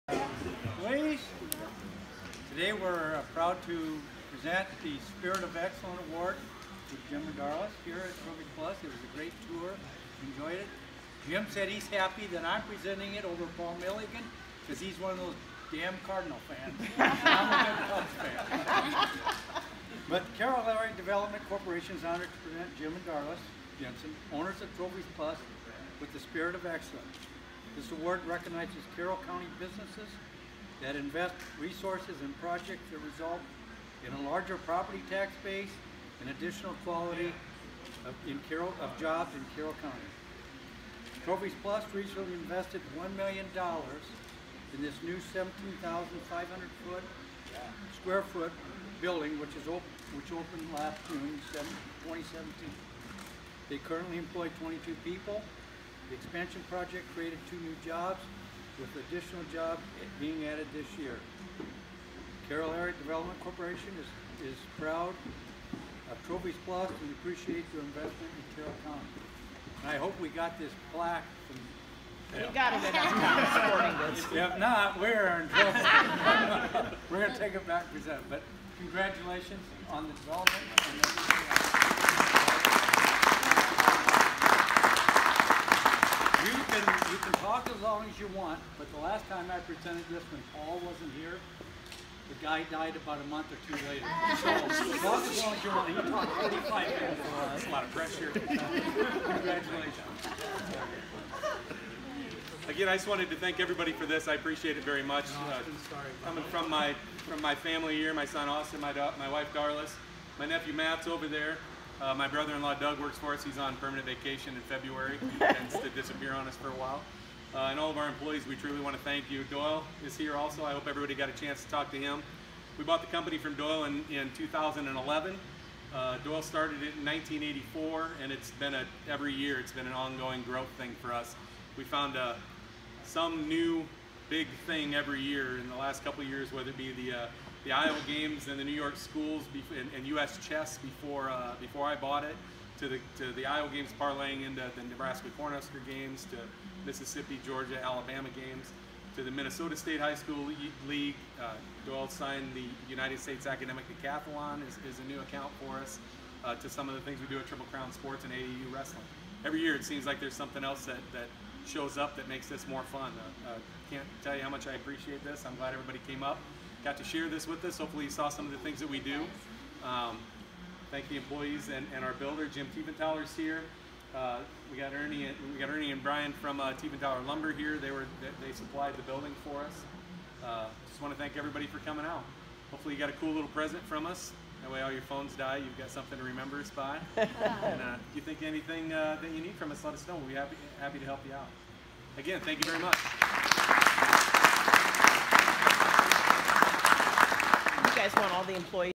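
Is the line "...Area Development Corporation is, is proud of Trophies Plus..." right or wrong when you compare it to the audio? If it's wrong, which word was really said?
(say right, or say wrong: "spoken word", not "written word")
right.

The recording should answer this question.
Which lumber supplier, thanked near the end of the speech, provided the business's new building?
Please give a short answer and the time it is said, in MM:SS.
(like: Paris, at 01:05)
Tiefenthaler Lumber, at 02:56.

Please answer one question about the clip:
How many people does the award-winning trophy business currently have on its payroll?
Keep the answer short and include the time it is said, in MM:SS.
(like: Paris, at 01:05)
22, at 00:54.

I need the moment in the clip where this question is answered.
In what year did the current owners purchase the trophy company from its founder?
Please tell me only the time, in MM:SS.
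02:04.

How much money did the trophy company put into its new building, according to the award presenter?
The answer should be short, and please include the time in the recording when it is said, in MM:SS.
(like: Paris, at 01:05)
$1 million, at 00:42.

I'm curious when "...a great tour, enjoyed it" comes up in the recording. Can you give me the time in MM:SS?
00:09.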